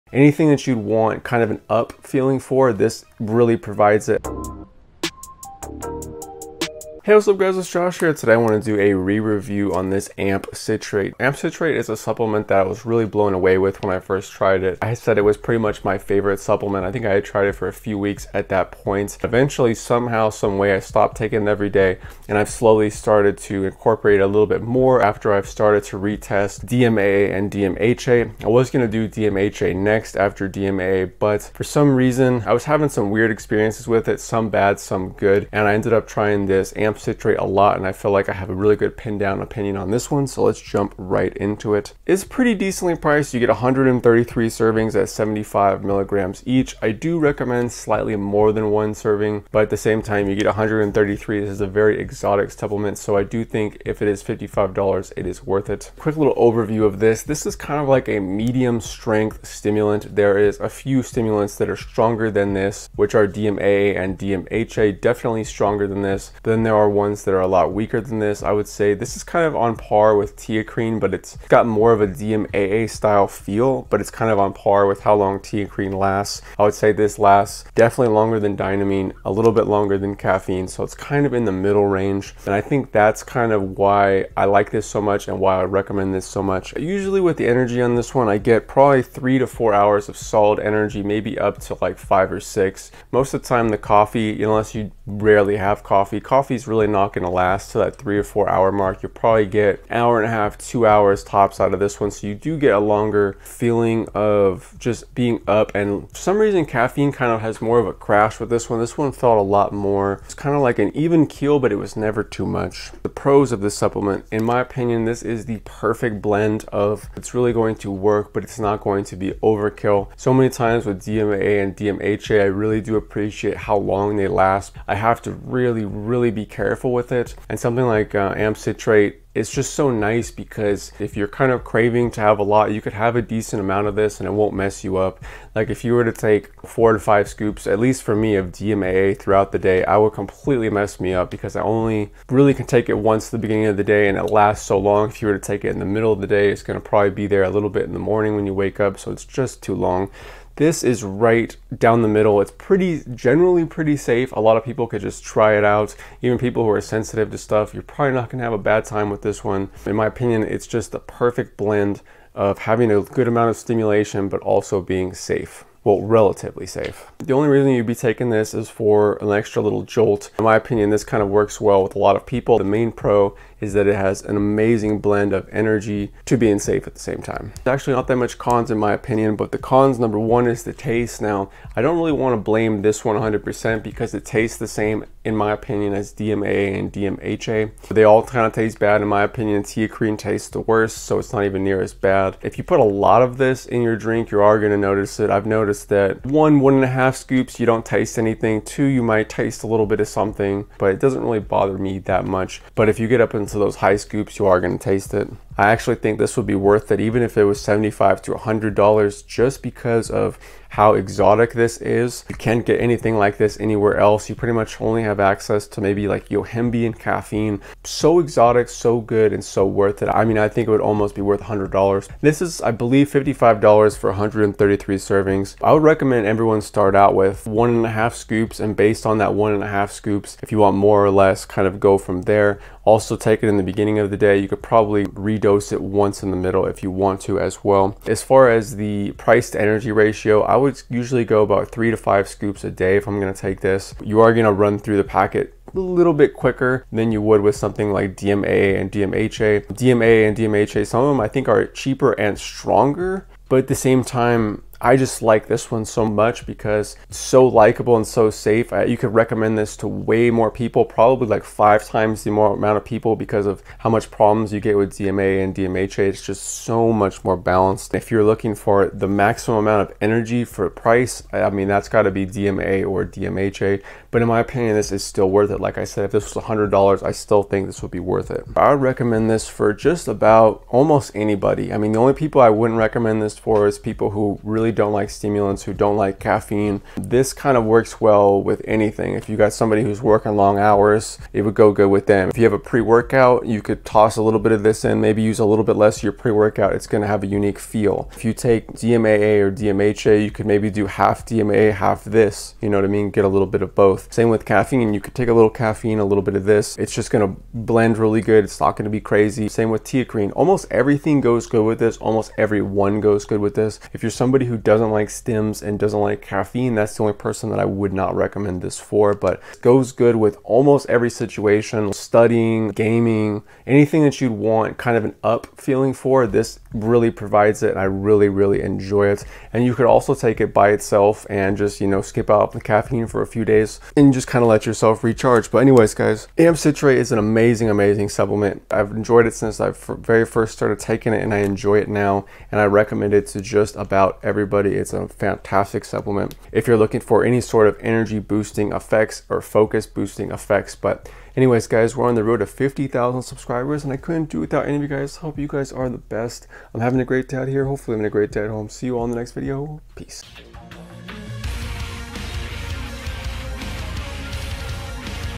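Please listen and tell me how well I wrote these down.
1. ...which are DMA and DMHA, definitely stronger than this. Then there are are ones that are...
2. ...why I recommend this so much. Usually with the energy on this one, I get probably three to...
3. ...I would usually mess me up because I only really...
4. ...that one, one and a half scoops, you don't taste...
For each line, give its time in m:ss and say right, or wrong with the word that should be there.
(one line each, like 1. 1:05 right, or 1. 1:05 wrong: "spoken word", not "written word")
1. 1:02 right
2. 1:25 right
3. 2:19 wrong: "completely", not "usually"
4. 3:15 right.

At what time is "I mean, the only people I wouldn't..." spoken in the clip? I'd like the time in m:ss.
4:41.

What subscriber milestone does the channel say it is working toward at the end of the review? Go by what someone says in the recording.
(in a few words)
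50,000.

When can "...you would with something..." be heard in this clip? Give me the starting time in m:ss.
4:07.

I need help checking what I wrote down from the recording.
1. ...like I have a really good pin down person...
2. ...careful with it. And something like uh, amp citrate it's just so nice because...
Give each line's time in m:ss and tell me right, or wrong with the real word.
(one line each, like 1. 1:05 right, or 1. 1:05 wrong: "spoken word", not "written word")
1. 0:38 wrong: "opinion", not "person"
2. 2:06 right.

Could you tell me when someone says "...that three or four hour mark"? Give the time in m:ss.
1:37.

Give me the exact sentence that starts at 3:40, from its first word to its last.
I mean, I think it would almost be worth $100.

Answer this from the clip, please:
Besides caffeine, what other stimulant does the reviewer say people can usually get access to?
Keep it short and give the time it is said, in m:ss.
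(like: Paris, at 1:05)
Yohimbe, at 3:36.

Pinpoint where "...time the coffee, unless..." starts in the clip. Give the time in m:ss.
1:33.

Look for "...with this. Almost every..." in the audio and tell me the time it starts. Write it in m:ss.
5:11.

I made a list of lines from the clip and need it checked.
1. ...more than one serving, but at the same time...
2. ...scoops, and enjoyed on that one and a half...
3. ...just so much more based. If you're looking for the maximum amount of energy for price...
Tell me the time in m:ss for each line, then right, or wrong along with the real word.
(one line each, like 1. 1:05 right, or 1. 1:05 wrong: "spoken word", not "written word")
1. 0:48 right
2. 3:48 wrong: "based", not "enjoyed"
3. 4:26 wrong: "balanced", not "based".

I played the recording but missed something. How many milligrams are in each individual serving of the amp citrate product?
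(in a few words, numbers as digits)
75 milligrams.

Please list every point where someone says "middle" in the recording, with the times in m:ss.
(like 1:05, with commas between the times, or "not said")
1:21, 2:25, 2:32, 3:56.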